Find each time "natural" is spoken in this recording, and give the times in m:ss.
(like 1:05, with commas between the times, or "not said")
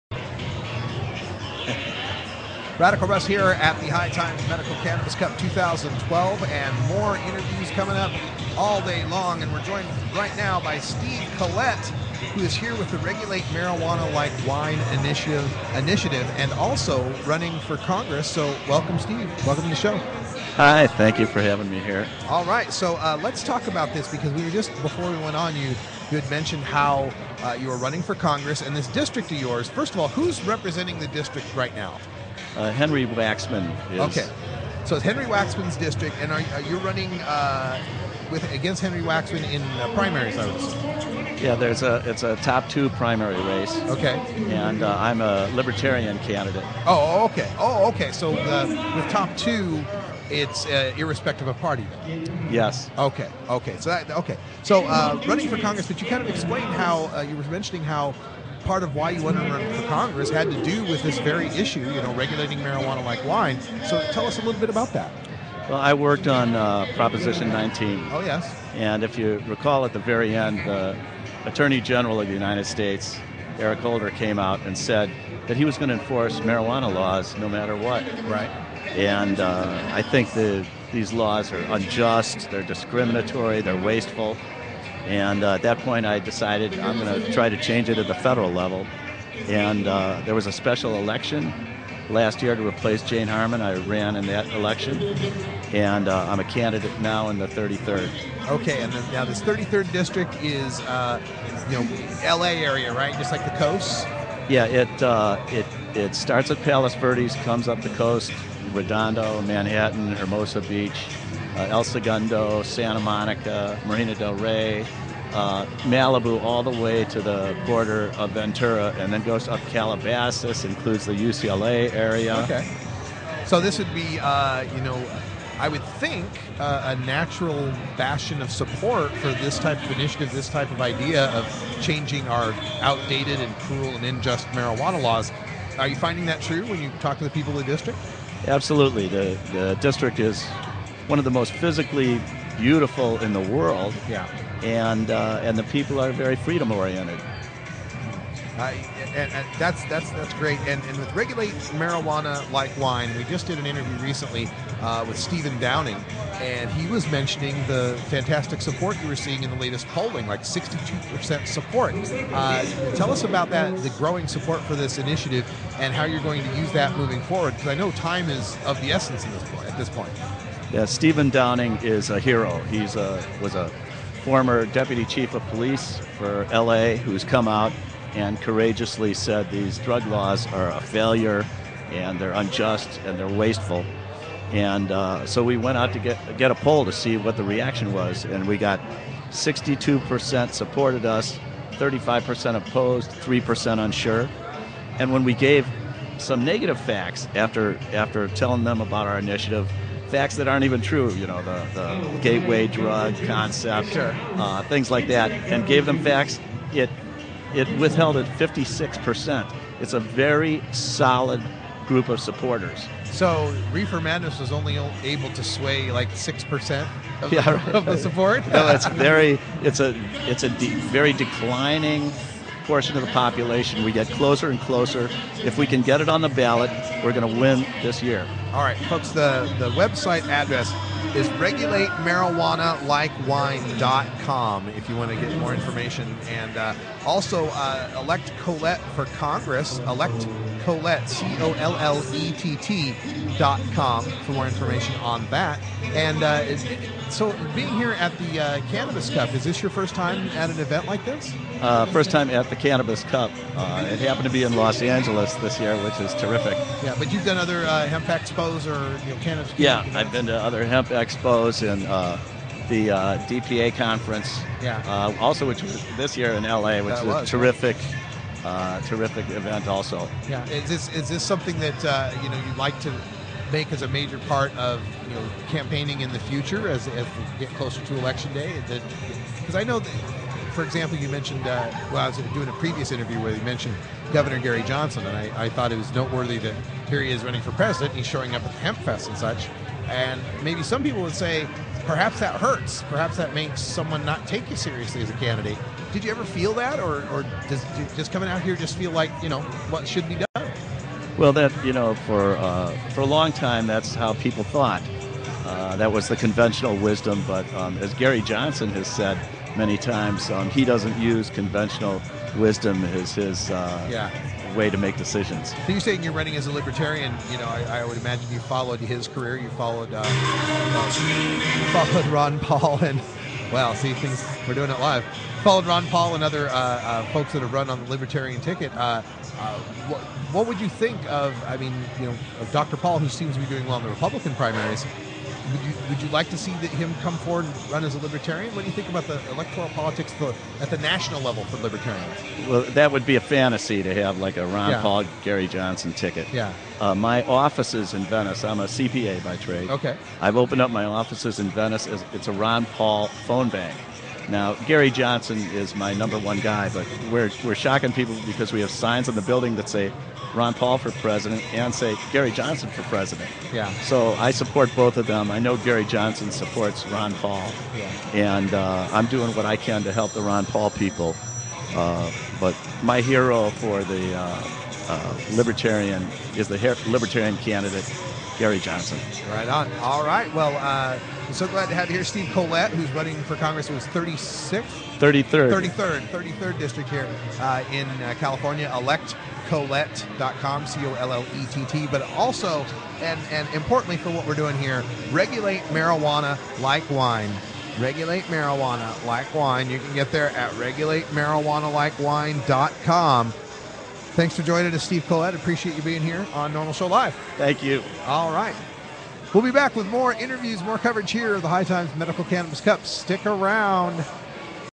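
2:07.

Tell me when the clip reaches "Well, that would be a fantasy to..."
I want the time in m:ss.
5:42.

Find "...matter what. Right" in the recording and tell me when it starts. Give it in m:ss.
1:17.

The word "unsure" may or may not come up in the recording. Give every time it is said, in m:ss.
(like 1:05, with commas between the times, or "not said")
3:13.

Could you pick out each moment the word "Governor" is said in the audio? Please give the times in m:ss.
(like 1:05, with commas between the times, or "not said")
4:44.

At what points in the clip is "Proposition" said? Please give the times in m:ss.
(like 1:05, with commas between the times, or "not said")
1:06.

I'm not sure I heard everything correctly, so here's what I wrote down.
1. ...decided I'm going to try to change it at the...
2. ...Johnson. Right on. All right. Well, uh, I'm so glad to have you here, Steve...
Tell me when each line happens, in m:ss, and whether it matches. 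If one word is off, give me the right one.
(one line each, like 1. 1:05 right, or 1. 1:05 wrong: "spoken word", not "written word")
1. 1:26 right
2. 6:18 right.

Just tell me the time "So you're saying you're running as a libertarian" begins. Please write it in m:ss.
5:15.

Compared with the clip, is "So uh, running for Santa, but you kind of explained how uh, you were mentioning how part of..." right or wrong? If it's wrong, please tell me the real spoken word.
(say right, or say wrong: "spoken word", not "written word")
wrong: "Congress", not "Santa".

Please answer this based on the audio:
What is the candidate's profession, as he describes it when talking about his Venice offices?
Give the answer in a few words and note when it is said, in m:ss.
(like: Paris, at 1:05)
CPA, at 5:48.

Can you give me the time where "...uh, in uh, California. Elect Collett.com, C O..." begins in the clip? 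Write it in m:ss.
6:27.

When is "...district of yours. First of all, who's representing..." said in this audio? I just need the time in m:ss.
0:28.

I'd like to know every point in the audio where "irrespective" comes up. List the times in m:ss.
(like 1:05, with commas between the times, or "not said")
0:50.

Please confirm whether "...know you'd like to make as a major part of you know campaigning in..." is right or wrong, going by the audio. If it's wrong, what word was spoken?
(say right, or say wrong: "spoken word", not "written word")
right.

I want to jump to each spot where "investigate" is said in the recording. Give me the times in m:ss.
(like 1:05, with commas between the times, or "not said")
not said.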